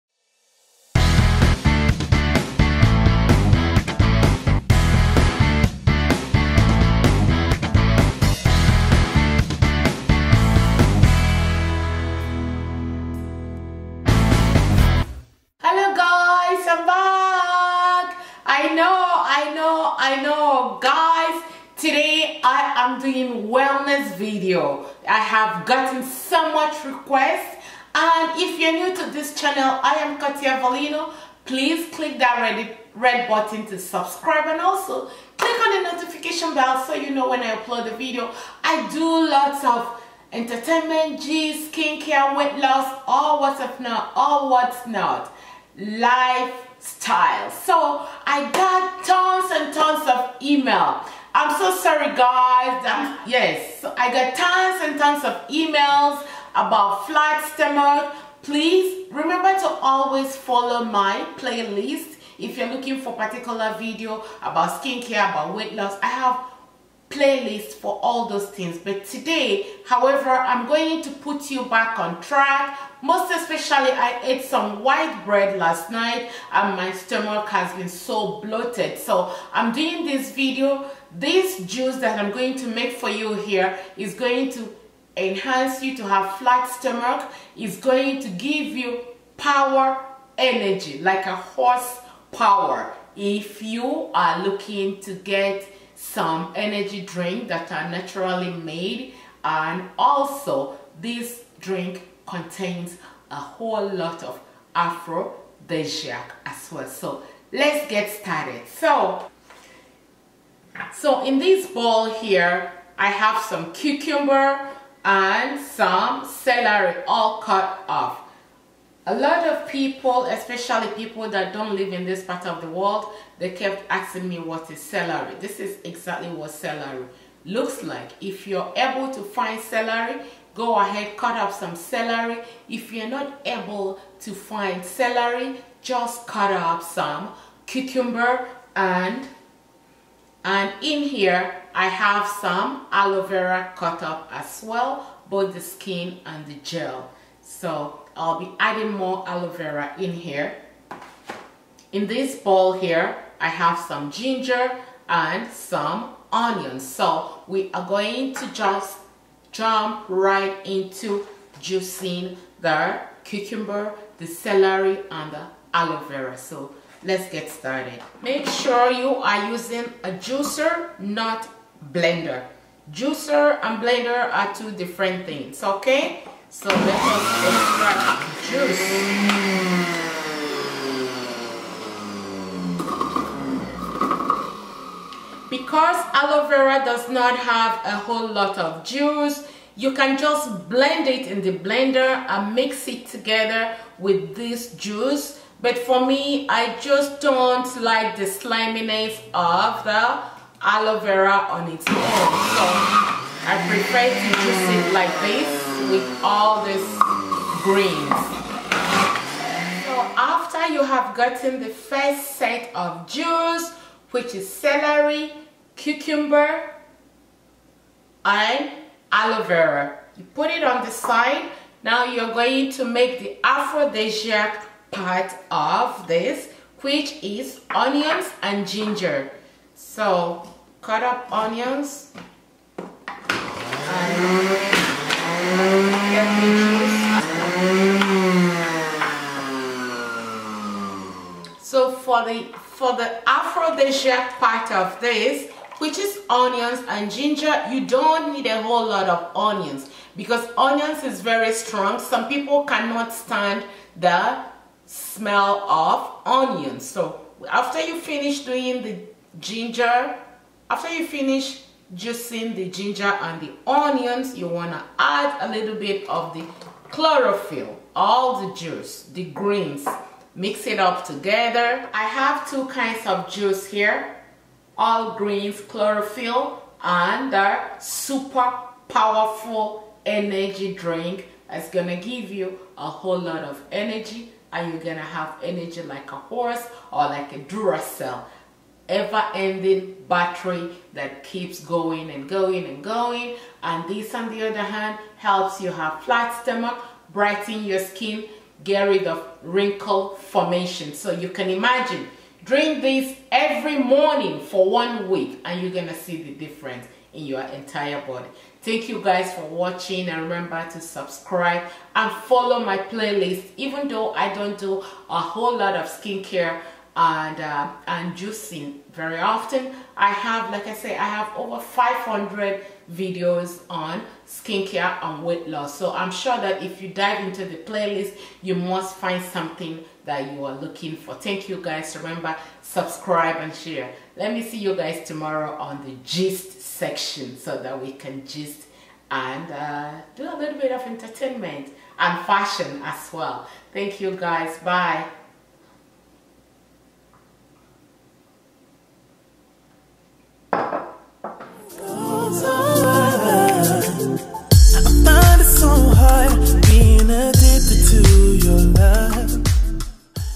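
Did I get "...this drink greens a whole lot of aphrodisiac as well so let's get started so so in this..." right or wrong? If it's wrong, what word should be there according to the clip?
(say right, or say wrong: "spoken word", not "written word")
wrong: "contains", not "greens".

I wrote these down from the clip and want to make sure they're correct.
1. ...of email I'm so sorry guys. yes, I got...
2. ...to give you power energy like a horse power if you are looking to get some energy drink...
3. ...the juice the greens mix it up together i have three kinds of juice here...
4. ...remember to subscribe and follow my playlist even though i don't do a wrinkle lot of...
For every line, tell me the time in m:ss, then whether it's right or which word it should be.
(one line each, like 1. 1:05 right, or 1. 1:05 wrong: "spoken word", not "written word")
1. 0:50 right
2. 1:28 right
3. 4:28 wrong: "two", not "three"
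4. 5:10 wrong: "whole", not "wrinkle".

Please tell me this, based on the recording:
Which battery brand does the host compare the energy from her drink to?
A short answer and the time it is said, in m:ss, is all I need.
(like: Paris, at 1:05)
Duracell, at 4:47.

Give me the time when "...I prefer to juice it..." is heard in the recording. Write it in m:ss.
3:23.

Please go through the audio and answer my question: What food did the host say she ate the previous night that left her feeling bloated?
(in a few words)
white bread.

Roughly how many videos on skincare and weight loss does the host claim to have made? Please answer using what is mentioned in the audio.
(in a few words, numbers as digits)
over 500.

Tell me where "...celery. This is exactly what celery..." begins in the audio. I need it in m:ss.
2:04.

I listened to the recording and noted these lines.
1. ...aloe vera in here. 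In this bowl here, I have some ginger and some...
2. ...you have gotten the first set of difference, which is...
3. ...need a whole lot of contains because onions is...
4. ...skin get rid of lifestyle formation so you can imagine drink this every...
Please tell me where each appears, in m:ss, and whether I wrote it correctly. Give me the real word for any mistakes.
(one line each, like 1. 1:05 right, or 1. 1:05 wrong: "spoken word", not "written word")
1. 2:29 right
2. 3:30 wrong: "juice", not "difference"
3. 4:08 wrong: "onions", not "contains"
4. 4:57 wrong: "wrinkle", not "lifestyle".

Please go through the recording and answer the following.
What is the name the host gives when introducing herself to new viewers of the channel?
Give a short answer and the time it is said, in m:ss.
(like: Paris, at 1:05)
Kartia Velino, at 0:30.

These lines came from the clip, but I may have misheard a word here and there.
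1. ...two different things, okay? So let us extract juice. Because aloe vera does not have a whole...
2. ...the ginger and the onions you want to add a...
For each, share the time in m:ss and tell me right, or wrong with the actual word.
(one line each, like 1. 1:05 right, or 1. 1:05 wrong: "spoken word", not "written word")
1. 2:54 right
2. 4:22 right.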